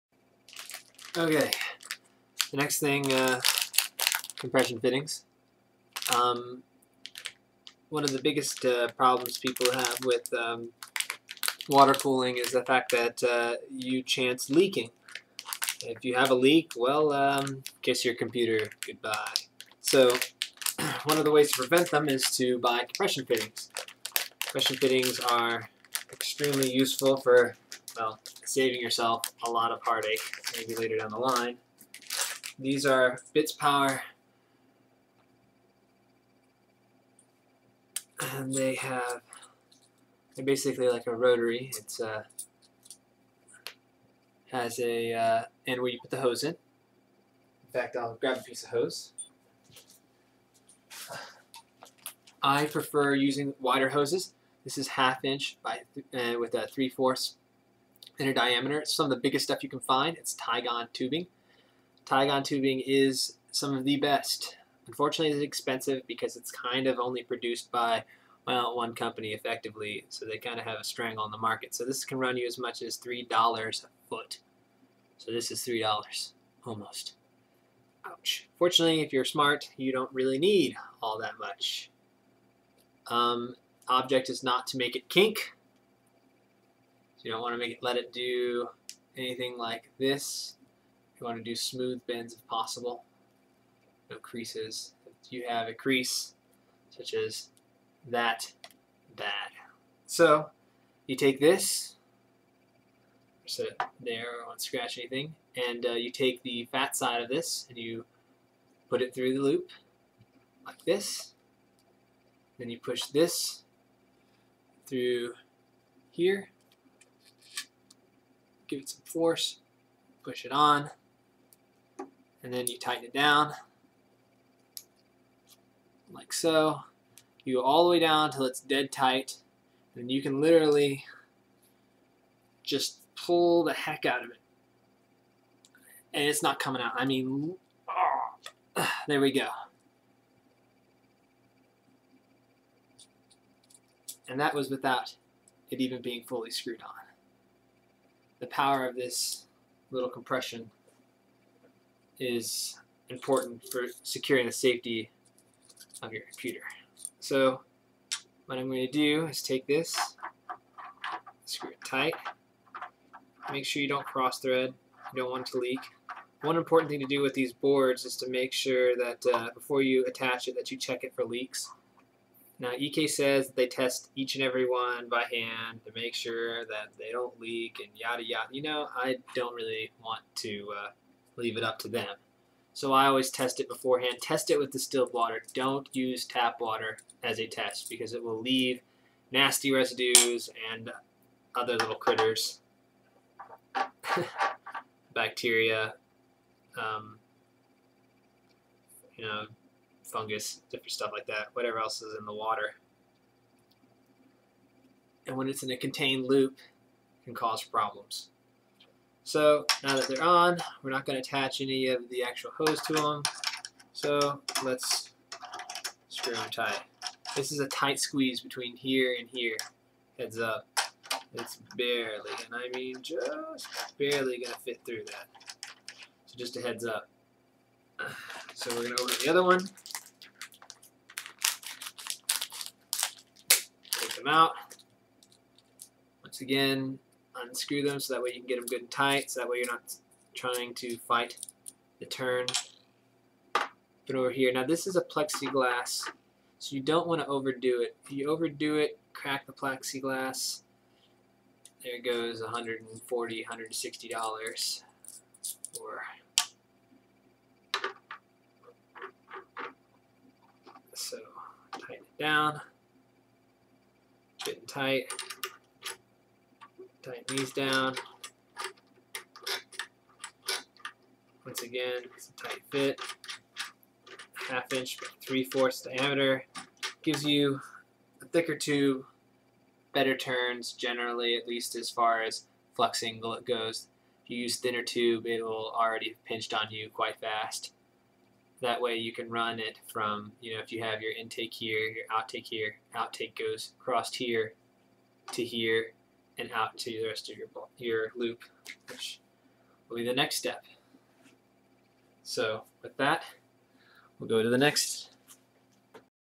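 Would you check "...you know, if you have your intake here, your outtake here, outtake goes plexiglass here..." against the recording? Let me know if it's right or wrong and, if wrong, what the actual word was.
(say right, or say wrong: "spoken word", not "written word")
wrong: "across", not "plexiglass".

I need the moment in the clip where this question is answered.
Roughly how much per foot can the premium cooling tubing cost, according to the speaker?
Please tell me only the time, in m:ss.
1:12.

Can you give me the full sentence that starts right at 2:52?
Now EK says they test each and every one by hand to make sure that they don't leak and yada yada.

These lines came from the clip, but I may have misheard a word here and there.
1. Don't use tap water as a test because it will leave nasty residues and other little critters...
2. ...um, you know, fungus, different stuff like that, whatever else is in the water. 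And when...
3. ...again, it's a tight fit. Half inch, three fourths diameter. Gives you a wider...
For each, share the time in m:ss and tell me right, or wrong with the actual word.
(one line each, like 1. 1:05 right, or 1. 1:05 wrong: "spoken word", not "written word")
1. 3:05 right
2. 3:16 right
3. 4:31 wrong: "thicker", not "wider".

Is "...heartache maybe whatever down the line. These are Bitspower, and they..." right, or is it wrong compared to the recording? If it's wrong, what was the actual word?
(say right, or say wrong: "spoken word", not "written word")
wrong: "later", not "whatever".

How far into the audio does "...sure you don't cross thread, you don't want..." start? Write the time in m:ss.
2:43.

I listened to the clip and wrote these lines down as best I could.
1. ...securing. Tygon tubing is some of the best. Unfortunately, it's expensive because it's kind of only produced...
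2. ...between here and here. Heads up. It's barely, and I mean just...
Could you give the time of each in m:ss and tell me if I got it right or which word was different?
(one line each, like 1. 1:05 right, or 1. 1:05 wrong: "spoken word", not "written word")
1. 1:00 wrong: "tubing", not "securing"
2. 3:38 right.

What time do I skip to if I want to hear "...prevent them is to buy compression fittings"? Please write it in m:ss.
0:21.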